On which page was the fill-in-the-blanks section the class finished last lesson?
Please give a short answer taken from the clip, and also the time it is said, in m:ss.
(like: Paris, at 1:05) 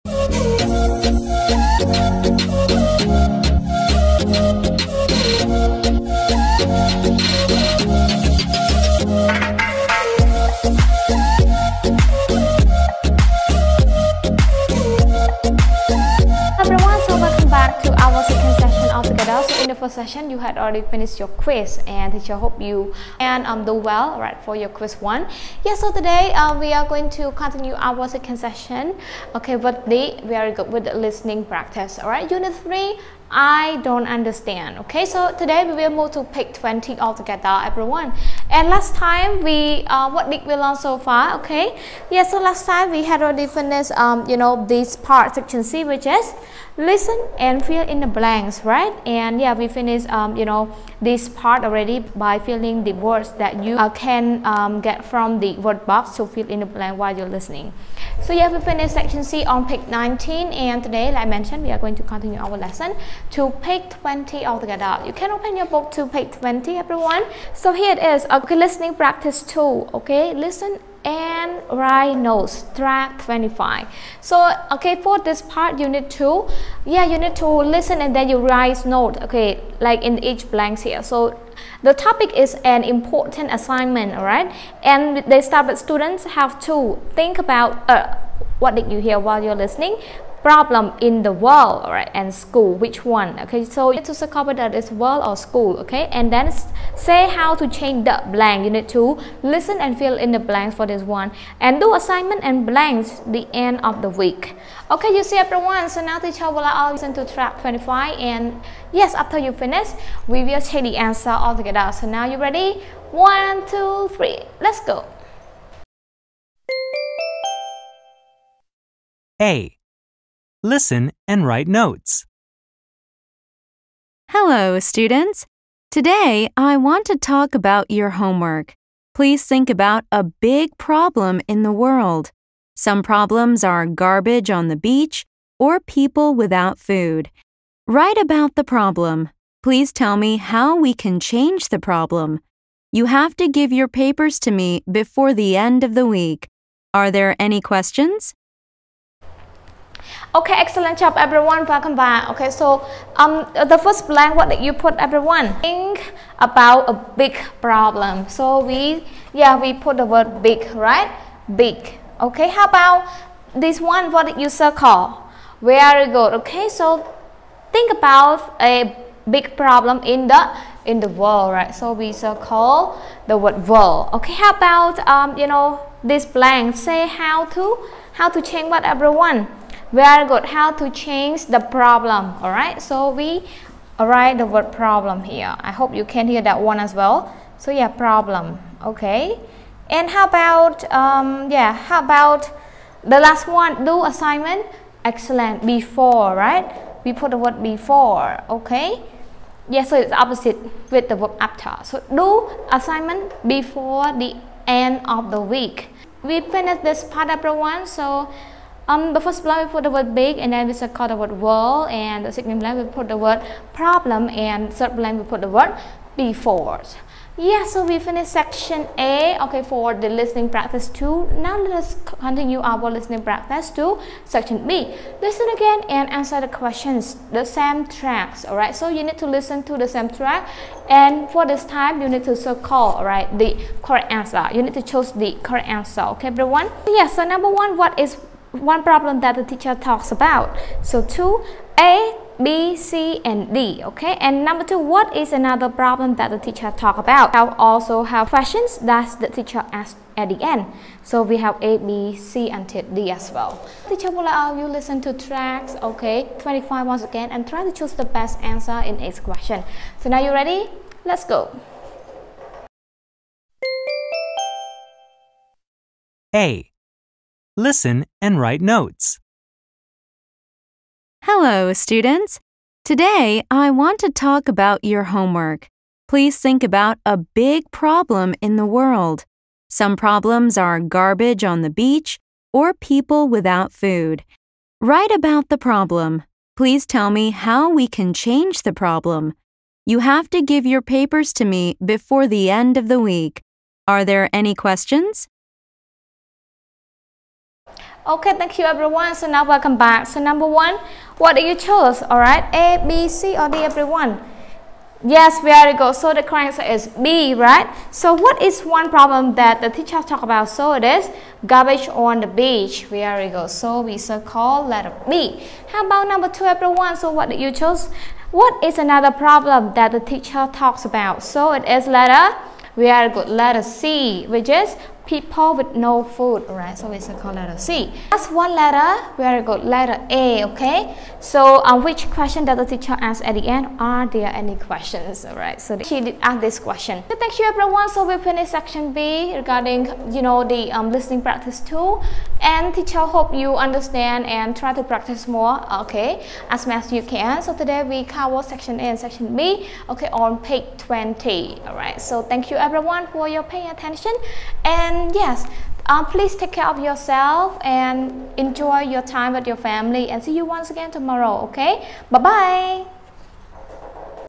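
page 19, at 0:59.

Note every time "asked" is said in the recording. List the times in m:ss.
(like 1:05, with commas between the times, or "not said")
4:09.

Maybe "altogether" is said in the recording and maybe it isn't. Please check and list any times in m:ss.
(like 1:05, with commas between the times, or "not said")
0:36, 1:04.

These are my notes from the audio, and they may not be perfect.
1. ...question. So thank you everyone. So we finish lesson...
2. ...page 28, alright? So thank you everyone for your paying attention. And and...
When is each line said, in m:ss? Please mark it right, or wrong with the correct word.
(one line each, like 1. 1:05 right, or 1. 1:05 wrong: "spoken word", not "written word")
1. 5:36 wrong: "section", not "lesson"
2. 5:50 wrong: "20", not "28".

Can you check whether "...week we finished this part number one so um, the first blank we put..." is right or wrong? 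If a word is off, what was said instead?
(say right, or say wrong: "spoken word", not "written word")
right.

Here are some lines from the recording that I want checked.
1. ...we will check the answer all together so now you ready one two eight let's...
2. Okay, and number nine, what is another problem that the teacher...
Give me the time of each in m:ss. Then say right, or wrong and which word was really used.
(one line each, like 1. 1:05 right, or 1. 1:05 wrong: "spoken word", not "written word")
1. 1:50 wrong: "three", not "eight"
2. 4:03 wrong: "two", not "nine".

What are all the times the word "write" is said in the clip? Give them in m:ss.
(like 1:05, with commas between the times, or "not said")
1:11, 1:18, 2:01, 2:17, 3:03, 4:28, 4:44.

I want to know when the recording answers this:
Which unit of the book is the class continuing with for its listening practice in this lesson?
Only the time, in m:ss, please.
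0:32.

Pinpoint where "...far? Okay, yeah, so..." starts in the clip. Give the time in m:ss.
0:40.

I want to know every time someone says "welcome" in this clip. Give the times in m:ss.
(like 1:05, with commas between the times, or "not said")
2:31, 4:59.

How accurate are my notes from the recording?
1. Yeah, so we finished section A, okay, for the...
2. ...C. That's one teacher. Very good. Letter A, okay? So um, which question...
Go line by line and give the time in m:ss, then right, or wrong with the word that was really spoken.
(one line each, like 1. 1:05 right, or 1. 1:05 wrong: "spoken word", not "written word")
1. 3:37 right
2. 5:27 wrong: "letter", not "teacher".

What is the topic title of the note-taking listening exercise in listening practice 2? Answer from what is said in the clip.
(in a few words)
An important assignment.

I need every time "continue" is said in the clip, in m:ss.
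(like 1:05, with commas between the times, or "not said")
0:27, 1:02, 3:42.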